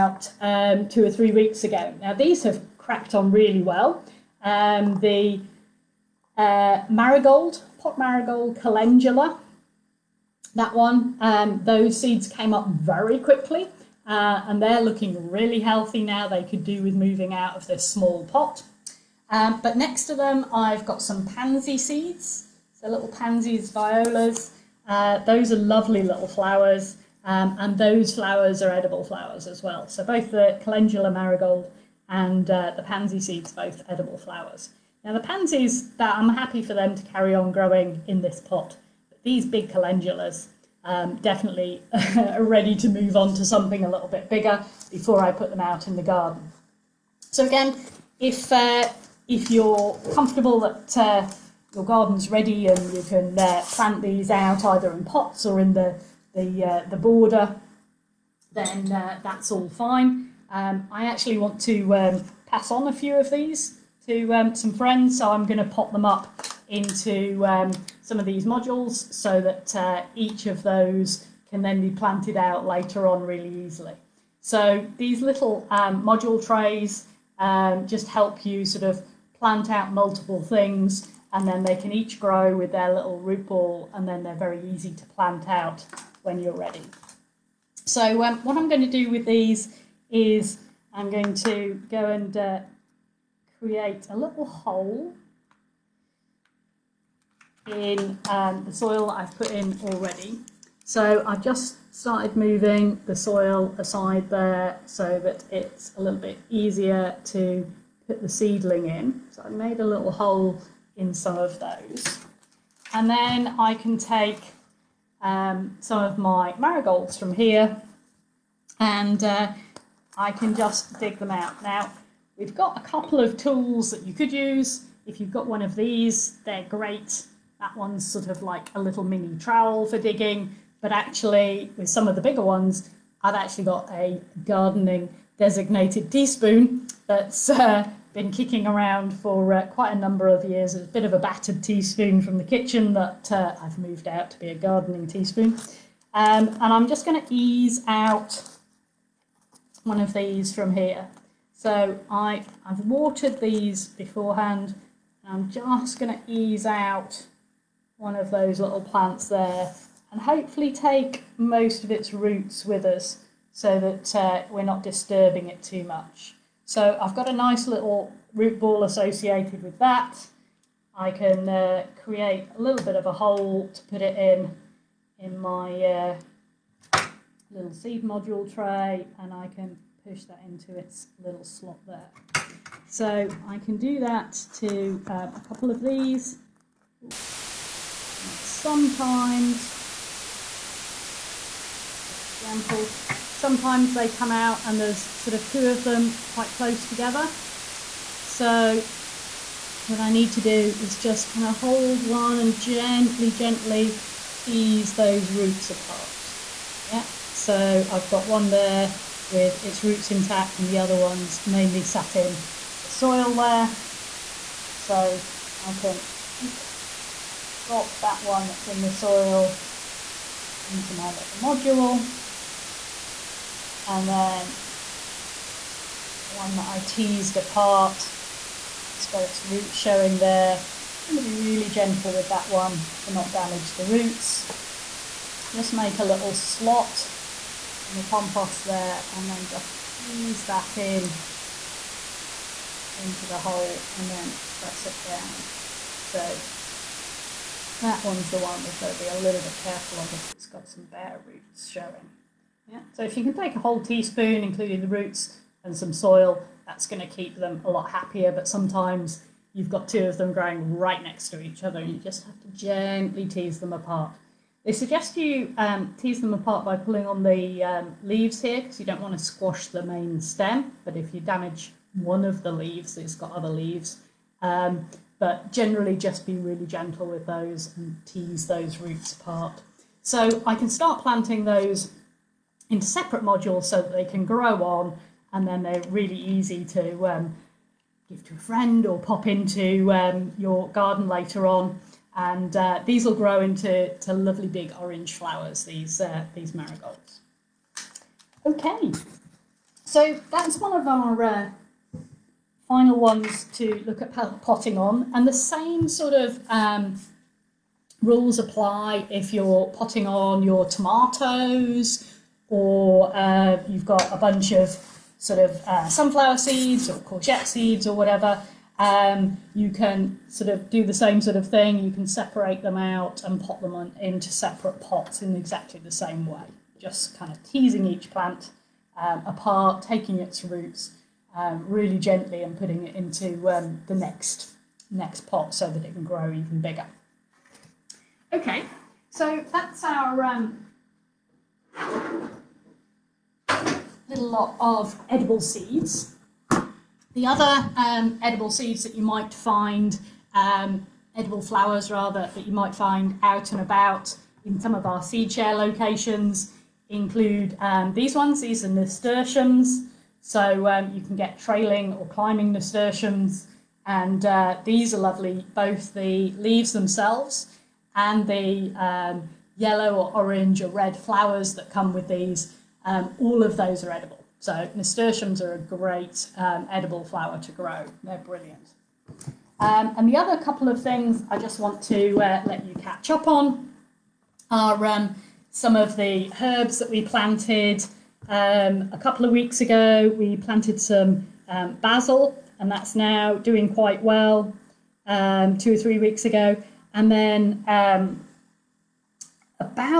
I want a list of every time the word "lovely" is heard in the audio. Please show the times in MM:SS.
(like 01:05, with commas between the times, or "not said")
00:25, 04:54, 06:04.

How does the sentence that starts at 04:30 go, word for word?
But if you damage one of the leaves, it's got other leaves.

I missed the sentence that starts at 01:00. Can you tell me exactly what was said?
Um, I actually want to um, pass on a few of these to um, some friends.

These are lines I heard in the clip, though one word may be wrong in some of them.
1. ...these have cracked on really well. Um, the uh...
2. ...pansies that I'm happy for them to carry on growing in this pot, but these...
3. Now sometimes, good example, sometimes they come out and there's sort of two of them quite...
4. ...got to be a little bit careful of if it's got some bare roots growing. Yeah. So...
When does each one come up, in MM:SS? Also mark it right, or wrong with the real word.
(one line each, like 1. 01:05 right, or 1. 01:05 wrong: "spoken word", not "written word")
1. 00:02 right
2. 00:35 right
3. 03:08 right
4. 04:08 wrong: "showing", not "growing".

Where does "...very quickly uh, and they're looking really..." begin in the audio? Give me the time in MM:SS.
00:12.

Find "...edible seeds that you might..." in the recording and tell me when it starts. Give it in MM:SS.
05:48.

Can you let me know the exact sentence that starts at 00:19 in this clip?
Um, but next to them, I've got some pansy seeds.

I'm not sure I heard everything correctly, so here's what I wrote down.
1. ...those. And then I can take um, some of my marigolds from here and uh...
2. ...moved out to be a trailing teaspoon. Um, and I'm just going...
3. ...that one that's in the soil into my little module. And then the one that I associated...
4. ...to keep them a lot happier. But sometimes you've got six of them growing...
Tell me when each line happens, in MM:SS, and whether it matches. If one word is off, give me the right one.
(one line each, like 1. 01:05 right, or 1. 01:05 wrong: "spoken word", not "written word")
1. 01:51 right
2. 02:23 wrong: "gardening", not "trailing"
3. 03:38 wrong: "teased", not "associated"
4. 04:17 wrong: "two", not "six".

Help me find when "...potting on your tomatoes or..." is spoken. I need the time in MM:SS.
05:09.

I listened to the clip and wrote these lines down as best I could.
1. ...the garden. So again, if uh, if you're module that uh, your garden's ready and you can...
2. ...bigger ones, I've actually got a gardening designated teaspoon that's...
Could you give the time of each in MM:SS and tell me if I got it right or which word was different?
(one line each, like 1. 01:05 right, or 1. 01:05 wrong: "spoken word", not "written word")
1. 00:45 wrong: "comfortable", not "module"
2. 02:12 right.